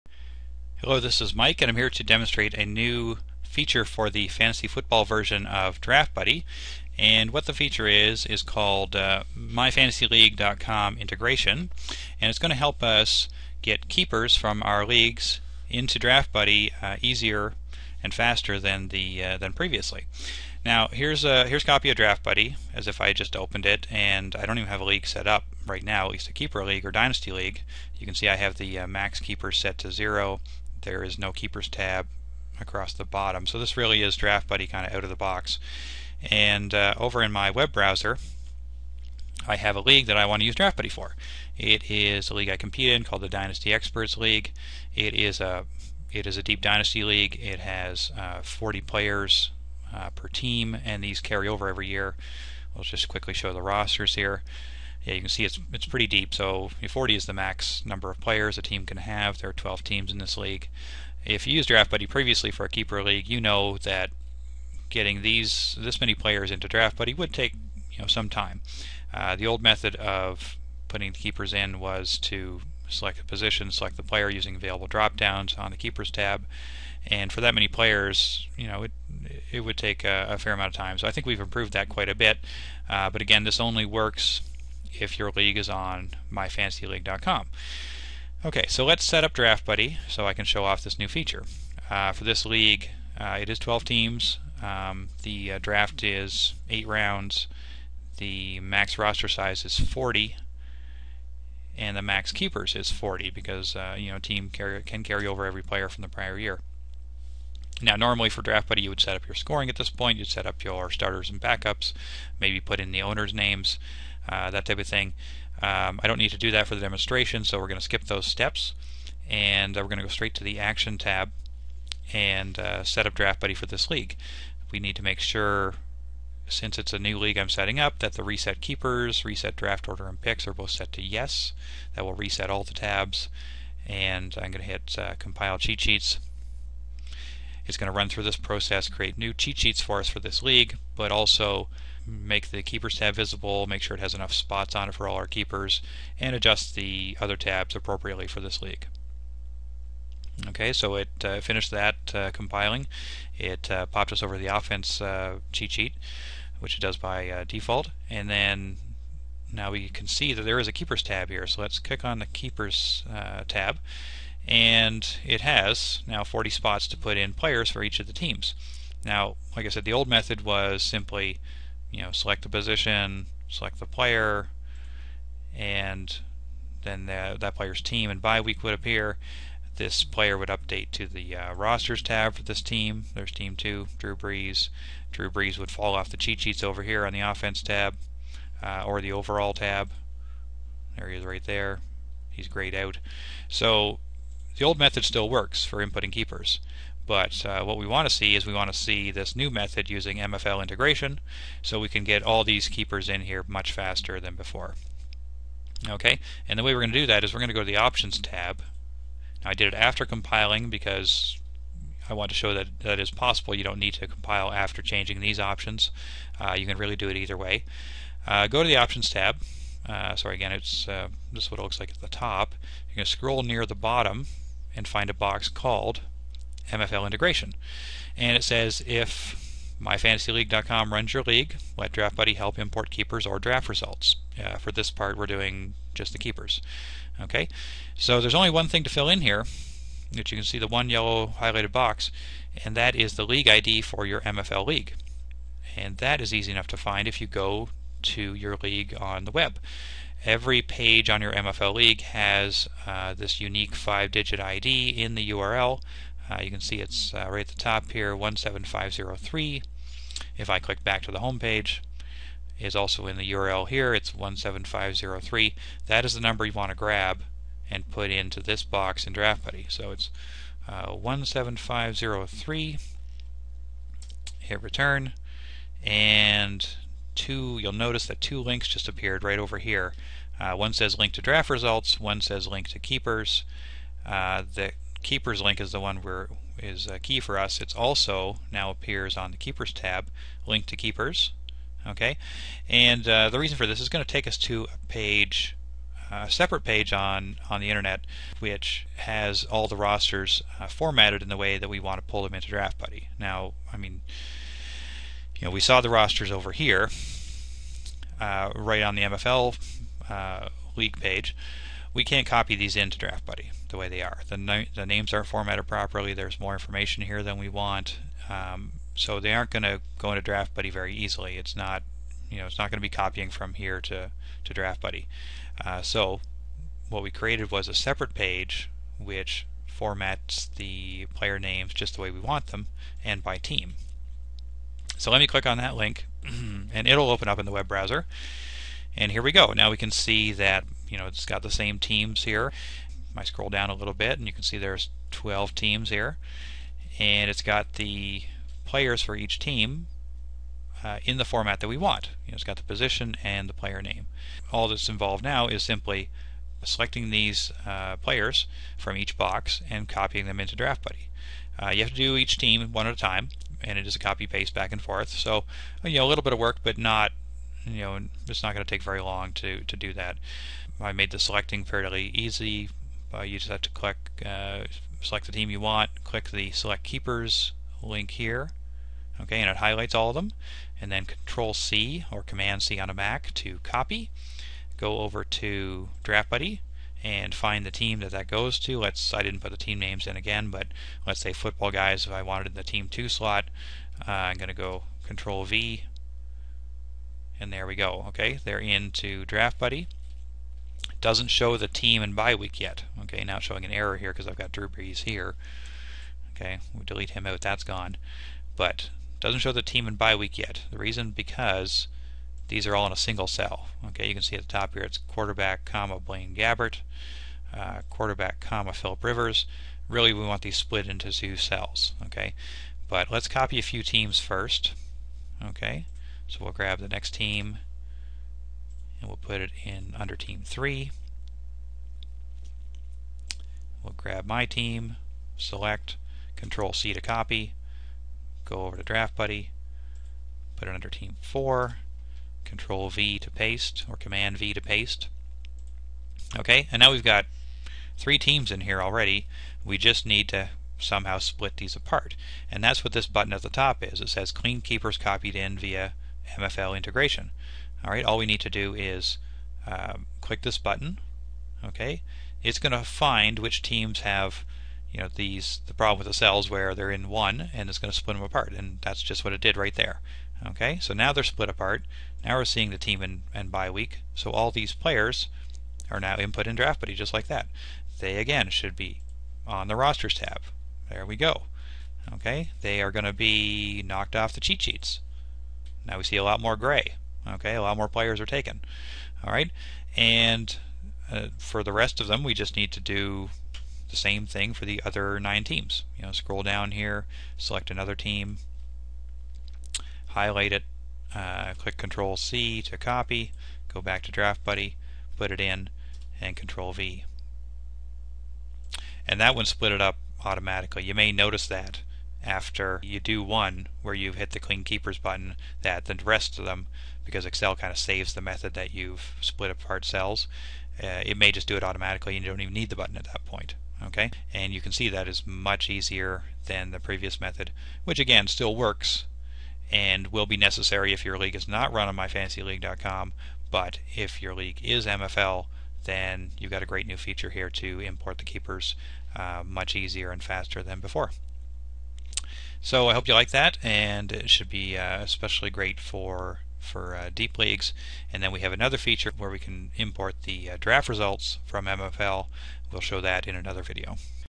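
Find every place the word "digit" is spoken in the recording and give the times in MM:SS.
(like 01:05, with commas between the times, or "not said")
04:14.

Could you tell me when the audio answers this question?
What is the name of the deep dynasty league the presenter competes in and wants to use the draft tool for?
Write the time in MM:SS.
00:43.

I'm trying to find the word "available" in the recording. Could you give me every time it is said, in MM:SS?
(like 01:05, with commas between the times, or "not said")
01:14.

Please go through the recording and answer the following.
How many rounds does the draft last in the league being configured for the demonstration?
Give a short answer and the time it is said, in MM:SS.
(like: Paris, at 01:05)
8, at 01:36.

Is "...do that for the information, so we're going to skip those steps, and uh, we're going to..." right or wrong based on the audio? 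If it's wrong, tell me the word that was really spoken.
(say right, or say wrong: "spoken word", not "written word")
wrong: "demonstration", not "information".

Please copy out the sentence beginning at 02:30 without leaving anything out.
Okay, so it uh, finished that uh, compiling.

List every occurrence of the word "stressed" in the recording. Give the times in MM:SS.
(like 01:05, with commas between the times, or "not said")
not said.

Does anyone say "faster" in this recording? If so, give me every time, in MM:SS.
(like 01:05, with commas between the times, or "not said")
00:18, 03:23, 09:00.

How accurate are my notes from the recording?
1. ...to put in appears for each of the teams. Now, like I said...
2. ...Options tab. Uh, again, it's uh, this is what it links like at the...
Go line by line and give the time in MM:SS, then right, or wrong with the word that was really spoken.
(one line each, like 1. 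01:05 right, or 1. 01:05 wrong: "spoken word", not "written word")
1. 02:46 wrong: "players", not "appears"
2. 03:38 wrong: "looks", not "links".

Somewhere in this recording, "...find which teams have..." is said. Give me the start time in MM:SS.
07:42.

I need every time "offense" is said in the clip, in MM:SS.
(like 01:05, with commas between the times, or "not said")
02:34, 03:07.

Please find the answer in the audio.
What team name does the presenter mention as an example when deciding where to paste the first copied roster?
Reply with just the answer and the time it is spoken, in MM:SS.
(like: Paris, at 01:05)
Football Guys, at 06:31.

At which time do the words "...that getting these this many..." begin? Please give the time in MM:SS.
01:03.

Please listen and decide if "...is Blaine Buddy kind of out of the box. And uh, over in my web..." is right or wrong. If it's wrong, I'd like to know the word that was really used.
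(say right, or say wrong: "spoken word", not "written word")
wrong: "Draft", not "Blaine".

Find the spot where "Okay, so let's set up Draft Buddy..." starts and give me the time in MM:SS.
01:28.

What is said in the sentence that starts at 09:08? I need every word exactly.
And then we have another feature where we can import the uh, draft results from MFL.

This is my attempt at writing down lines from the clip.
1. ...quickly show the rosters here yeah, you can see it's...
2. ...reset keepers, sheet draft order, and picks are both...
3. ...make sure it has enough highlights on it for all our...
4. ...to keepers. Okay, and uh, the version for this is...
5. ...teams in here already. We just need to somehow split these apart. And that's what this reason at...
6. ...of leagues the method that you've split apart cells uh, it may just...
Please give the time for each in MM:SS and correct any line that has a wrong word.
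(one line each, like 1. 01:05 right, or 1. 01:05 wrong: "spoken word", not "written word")
1. 00:53 right
2. 02:08 wrong: "reset", not "sheet"
3. 02:23 wrong: "spots", not "highlights"
4. 04:50 wrong: "reason", not "version"
5. 07:28 wrong: "button", not "reason"
6. 08:37 wrong: "saves", not "leagues".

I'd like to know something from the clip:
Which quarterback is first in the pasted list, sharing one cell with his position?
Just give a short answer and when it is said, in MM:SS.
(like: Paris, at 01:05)
Blaine Gabbert, at 06:56.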